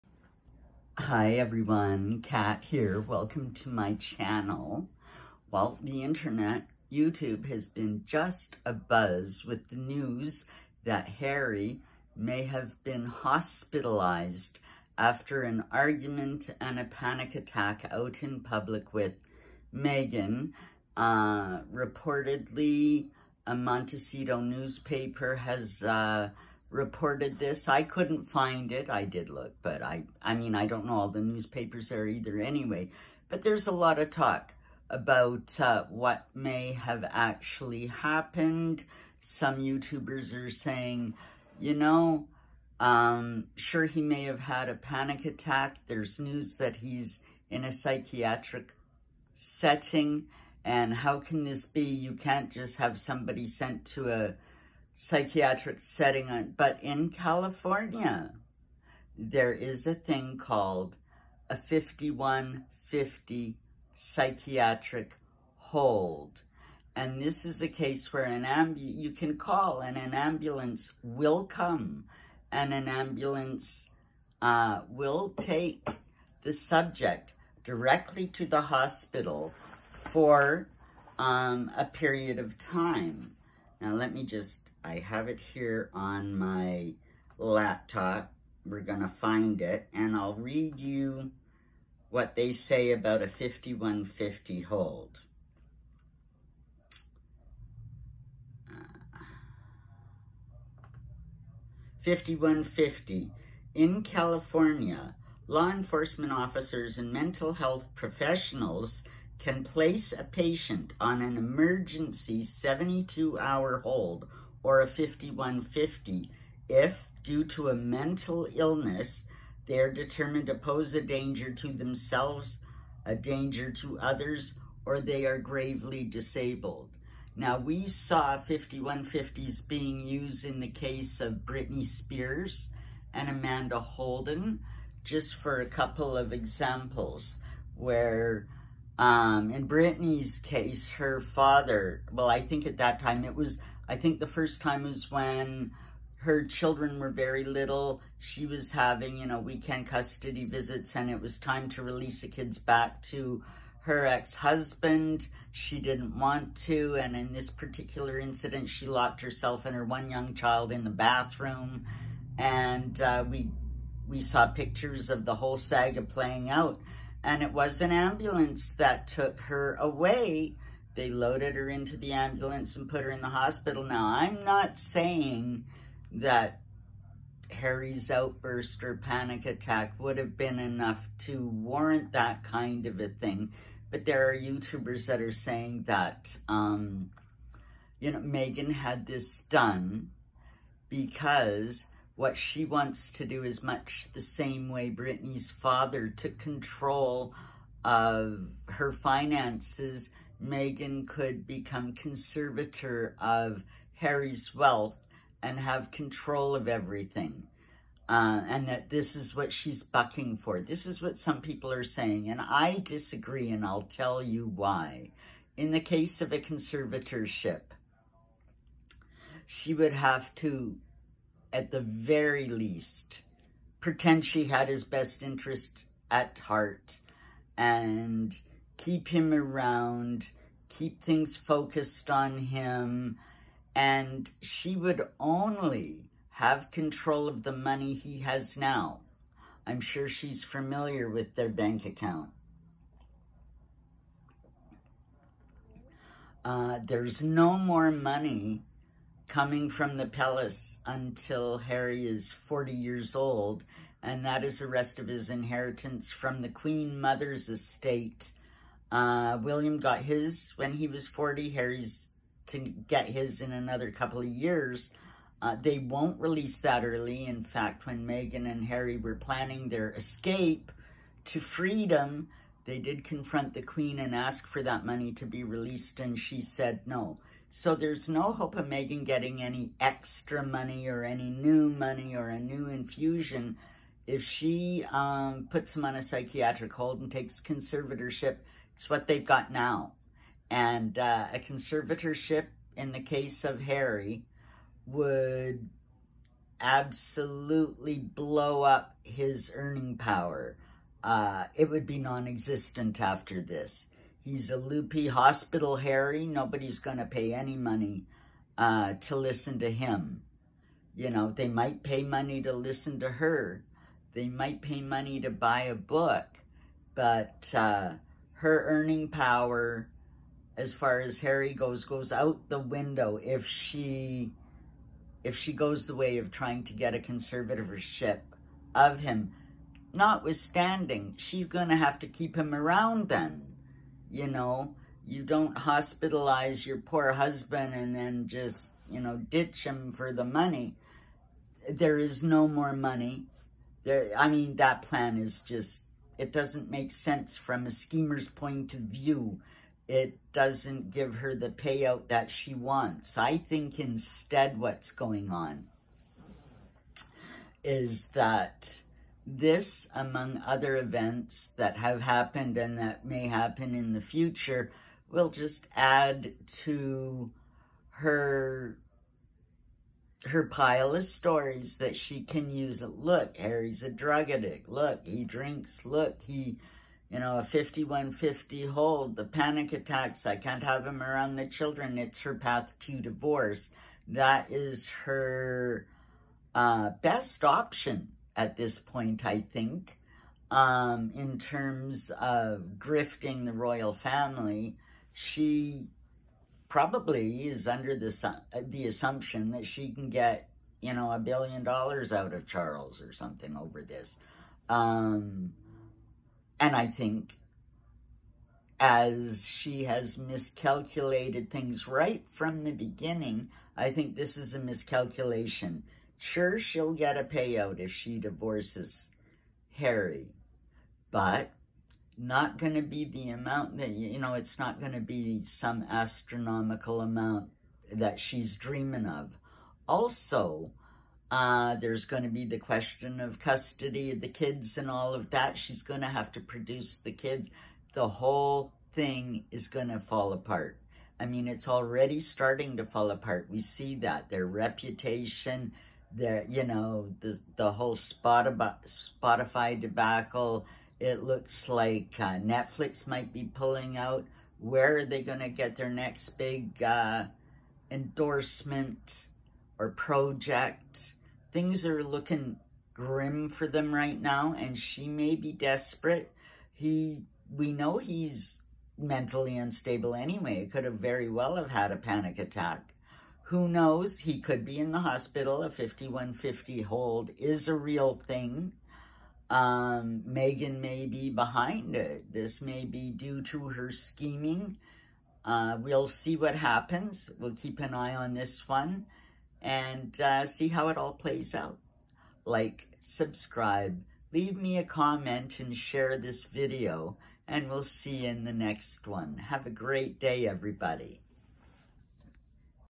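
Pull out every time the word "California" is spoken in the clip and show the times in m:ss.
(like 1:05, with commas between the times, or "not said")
0:57, 1:44.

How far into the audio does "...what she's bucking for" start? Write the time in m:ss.
3:29.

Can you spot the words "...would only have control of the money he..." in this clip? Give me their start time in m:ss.
3:54.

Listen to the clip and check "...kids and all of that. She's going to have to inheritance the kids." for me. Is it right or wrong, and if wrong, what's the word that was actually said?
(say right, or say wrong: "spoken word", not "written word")
wrong: "produce", not "inheritance".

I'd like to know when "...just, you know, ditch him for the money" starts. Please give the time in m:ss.
5:38.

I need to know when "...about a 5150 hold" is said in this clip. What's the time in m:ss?
1:32.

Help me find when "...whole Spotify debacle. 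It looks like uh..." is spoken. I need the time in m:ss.
7:27.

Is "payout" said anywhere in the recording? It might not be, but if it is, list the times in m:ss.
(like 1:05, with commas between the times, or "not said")
5:51, 6:57.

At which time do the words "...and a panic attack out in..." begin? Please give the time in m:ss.
0:16.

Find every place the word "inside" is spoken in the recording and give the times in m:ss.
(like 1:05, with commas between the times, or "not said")
not said.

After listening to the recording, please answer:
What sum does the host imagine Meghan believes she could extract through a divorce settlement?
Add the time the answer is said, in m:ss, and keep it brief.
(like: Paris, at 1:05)
a billion dollars, at 6:41.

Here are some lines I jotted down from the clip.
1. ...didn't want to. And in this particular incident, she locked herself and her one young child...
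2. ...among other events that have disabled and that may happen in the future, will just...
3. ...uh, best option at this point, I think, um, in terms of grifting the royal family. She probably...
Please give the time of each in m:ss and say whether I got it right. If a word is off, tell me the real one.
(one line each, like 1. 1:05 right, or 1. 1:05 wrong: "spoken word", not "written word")
1. 2:35 right
2. 5:59 wrong: "happened", not "disabled"
3. 6:26 right.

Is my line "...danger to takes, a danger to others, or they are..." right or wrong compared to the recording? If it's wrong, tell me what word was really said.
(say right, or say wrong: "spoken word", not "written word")
wrong: "themselves", not "takes".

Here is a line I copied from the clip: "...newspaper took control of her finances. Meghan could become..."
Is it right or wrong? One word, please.
wrong.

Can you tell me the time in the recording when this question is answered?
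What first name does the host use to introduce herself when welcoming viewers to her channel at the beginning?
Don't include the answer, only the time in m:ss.
0:02.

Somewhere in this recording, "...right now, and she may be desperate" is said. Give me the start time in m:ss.
7:43.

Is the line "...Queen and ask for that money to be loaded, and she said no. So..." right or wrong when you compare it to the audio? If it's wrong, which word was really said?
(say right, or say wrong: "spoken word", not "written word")
wrong: "released", not "loaded".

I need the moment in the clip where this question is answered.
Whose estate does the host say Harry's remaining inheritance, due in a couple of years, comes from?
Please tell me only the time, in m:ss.
4:16.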